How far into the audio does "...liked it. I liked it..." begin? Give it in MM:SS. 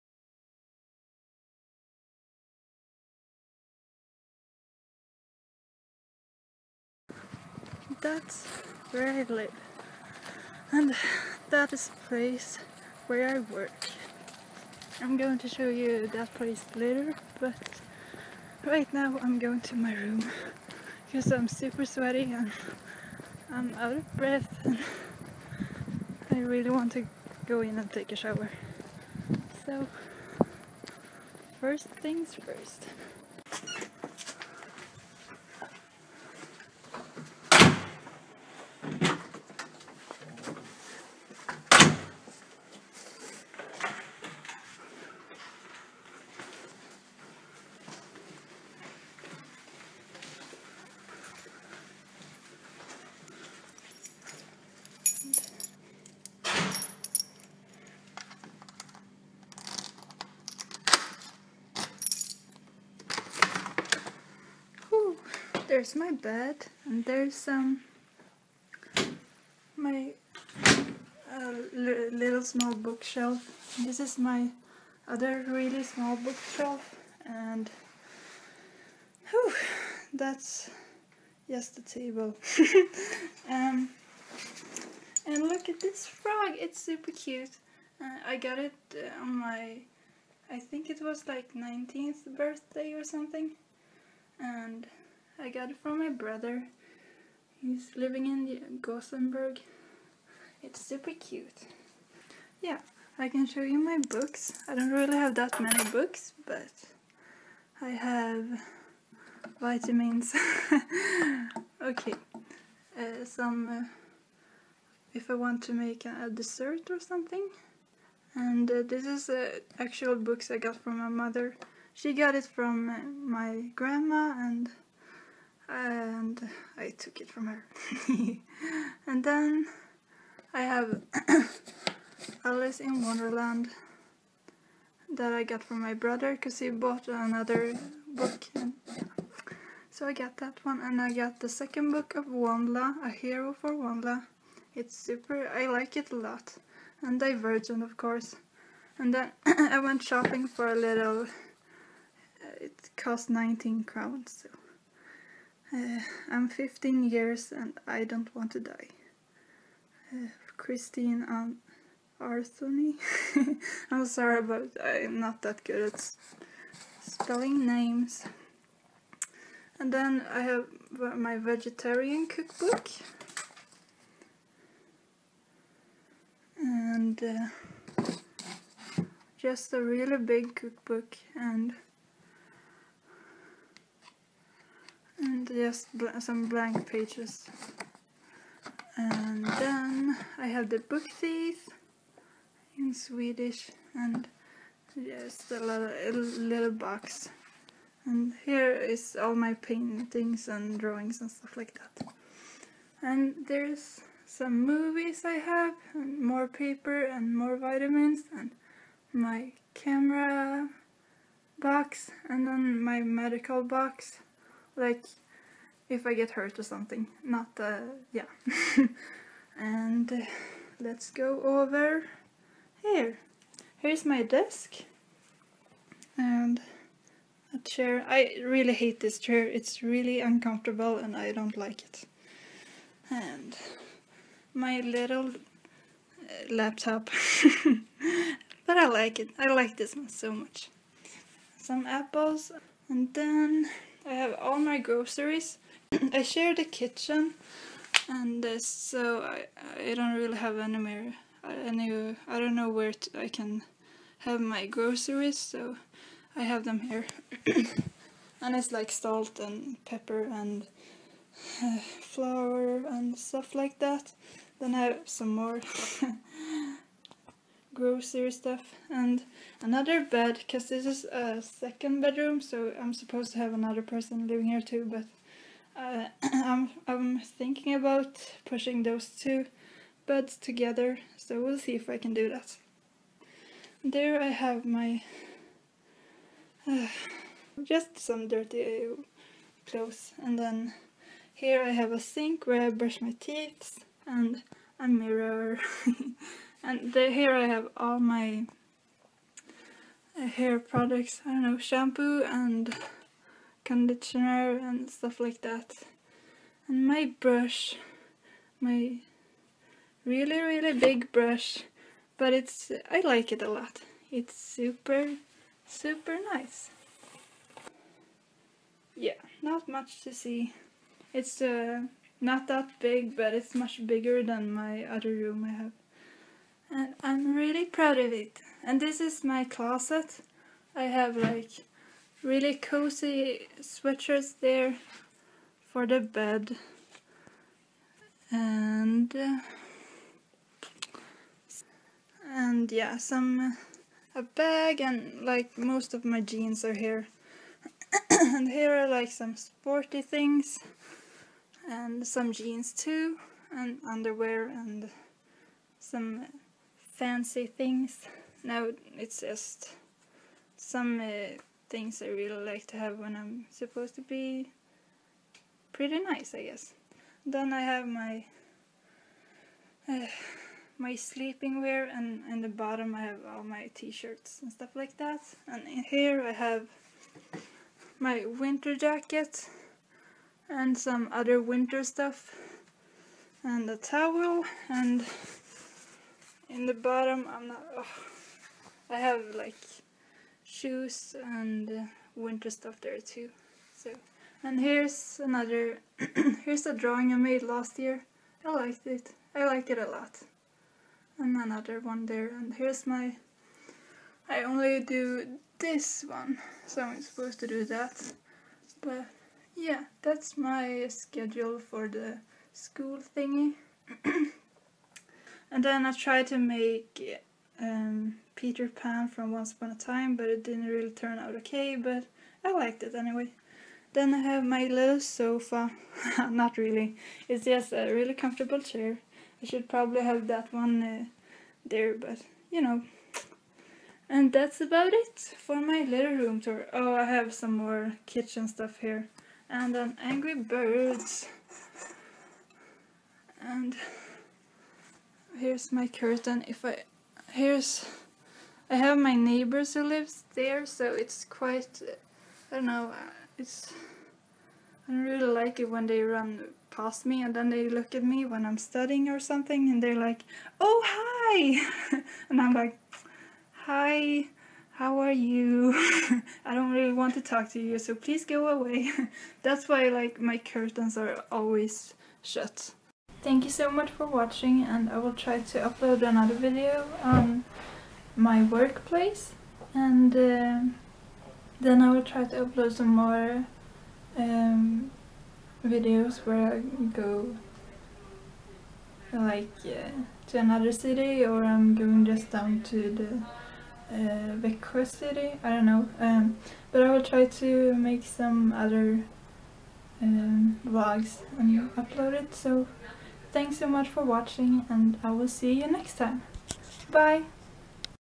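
06:38.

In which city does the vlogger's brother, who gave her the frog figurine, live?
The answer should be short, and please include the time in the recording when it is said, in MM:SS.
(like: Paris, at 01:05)
Gothenburg, at 01:38.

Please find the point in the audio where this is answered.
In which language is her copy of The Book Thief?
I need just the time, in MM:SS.
03:12.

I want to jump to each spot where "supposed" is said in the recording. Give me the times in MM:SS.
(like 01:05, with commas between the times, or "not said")
04:32, 06:03, 06:47.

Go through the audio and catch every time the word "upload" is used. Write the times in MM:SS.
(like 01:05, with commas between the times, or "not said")
07:55, 08:02, 08:21.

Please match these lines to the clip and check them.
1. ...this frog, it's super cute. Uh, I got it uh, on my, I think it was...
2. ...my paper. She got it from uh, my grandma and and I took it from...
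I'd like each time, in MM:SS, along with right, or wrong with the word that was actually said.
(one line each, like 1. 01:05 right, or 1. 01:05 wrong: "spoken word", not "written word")
1. 01:25 right
2. 02:00 wrong: "mother", not "paper".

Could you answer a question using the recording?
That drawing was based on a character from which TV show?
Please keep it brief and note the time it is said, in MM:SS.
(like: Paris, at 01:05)
Once Upon a Time, at 06:59.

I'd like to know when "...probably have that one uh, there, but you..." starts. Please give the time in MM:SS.
07:09.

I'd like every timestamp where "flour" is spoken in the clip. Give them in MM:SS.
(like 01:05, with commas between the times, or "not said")
04:22.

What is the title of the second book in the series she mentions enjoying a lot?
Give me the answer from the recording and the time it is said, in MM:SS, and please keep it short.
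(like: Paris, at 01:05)
A Hero for WondLa, at 02:23.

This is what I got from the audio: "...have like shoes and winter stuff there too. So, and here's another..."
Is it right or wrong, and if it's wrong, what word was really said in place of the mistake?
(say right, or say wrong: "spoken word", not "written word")
right.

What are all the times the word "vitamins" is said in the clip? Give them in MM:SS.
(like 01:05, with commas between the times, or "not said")
01:49, 03:27.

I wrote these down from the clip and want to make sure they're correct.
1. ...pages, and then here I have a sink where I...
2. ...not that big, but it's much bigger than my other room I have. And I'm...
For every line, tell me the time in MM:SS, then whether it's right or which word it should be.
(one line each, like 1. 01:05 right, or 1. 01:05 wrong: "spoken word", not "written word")
1. 04:49 wrong: "clothes", not "pages"
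2. 05:22 right.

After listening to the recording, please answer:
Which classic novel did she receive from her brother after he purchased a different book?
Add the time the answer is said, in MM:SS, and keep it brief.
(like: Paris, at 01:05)
Alice in Wonderland, at 02:12.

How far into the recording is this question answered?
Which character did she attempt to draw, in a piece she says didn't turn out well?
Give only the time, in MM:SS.
06:58.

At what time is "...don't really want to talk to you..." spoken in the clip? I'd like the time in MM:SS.
07:46.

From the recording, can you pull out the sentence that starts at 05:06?
And my brush, my really really big brush, but it's I like it a lot.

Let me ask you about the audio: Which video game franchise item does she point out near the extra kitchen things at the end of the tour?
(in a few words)
Angry Birds.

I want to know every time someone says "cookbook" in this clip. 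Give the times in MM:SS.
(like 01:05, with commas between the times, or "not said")
02:52, 03:00.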